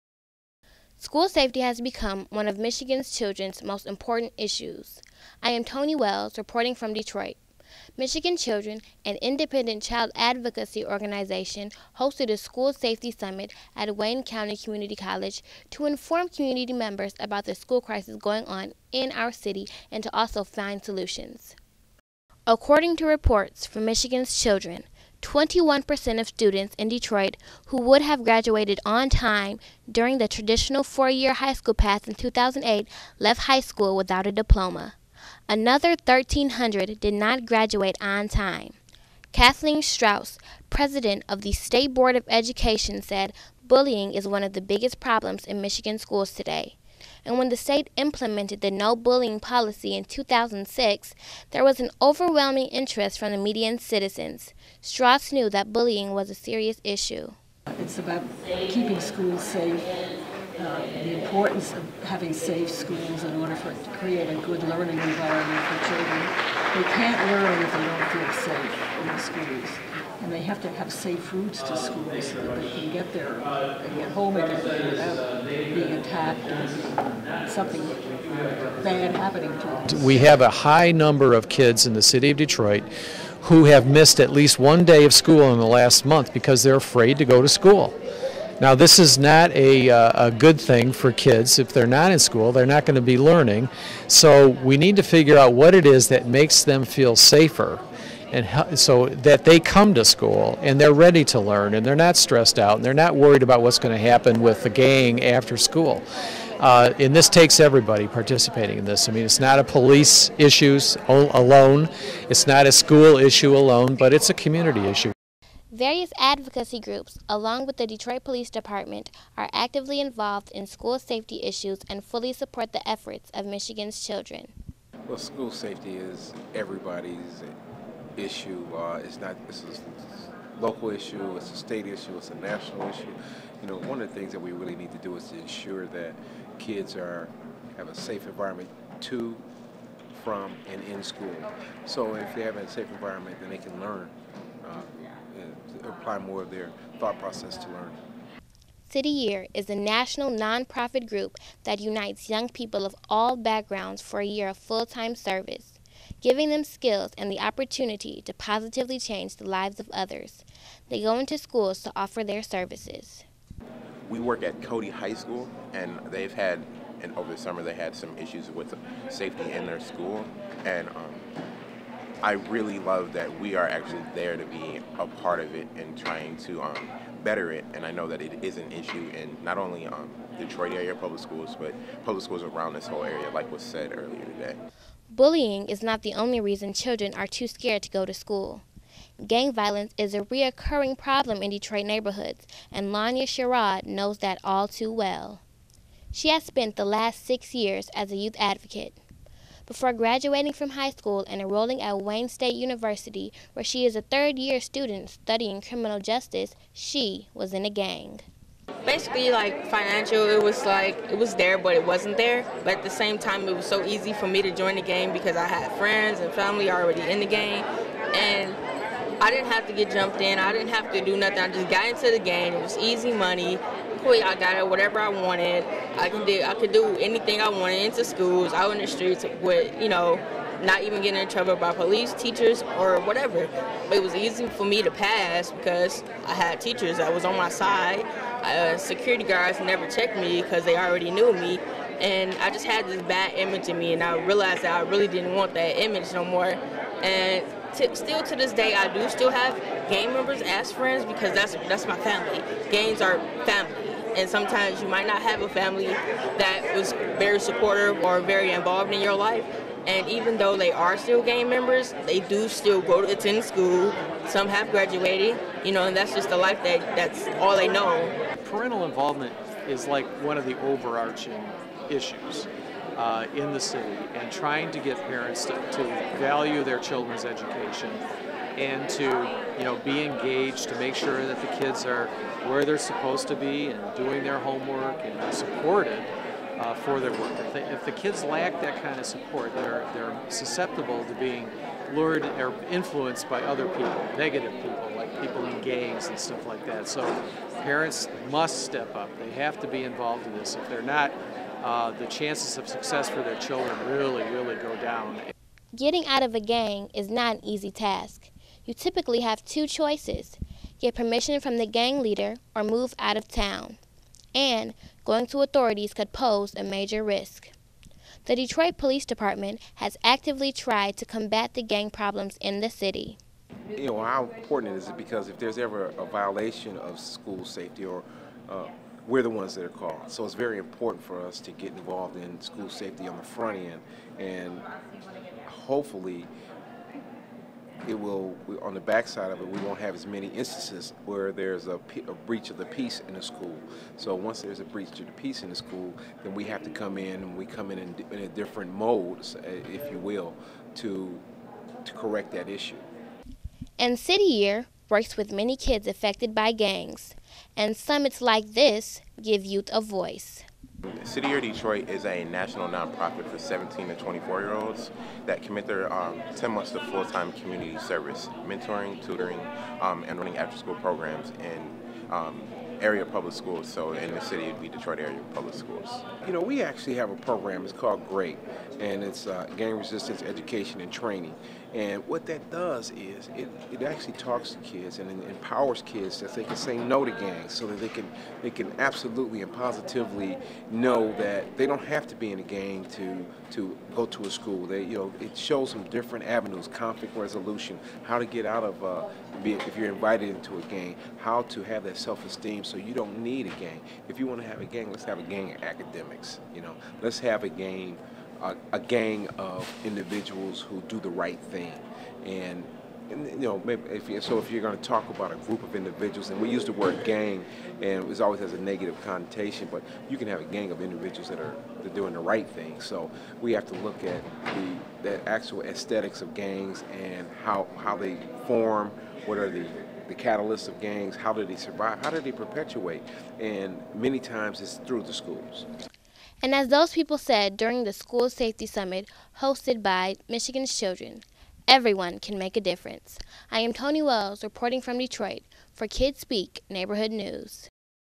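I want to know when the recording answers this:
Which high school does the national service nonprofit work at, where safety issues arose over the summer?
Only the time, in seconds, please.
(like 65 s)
164 s.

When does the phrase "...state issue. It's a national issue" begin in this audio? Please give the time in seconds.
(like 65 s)
131 s.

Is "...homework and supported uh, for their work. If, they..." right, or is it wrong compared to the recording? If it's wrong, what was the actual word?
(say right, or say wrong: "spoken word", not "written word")
right.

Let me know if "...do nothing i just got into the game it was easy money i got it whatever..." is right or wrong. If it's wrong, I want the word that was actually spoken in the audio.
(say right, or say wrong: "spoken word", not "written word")
right.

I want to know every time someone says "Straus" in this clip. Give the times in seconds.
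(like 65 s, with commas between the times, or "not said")
39 s, 54 s.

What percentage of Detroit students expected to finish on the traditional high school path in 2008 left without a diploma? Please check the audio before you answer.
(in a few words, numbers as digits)
21%.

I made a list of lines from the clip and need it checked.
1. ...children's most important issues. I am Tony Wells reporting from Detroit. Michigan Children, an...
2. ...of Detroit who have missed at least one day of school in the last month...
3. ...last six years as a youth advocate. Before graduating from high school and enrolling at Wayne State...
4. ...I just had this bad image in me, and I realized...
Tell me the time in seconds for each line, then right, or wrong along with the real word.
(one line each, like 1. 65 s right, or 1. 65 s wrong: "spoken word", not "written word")
1. 3 s right
2. 82 s right
3. 196 s right
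4. 242 s right.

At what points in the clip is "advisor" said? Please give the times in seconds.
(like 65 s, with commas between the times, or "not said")
not said.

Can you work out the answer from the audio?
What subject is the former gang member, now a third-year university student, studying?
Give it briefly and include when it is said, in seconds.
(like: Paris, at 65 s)
criminal justice, at 205 s.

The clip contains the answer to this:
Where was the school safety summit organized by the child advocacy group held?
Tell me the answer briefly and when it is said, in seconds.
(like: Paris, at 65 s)
Wayne County Community College, at 13 s.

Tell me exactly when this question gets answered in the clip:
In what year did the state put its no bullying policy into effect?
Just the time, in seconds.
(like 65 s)
50 s.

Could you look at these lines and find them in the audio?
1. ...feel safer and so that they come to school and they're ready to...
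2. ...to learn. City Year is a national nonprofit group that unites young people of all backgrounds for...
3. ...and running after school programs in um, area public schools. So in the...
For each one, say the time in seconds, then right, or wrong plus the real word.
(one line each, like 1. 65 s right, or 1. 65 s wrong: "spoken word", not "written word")
1. 96 s right
2. 147 s right
3. 370 s right.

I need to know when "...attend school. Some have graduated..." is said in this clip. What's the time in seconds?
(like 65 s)
263 s.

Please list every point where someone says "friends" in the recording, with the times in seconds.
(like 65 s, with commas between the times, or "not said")
215 s, 250 s.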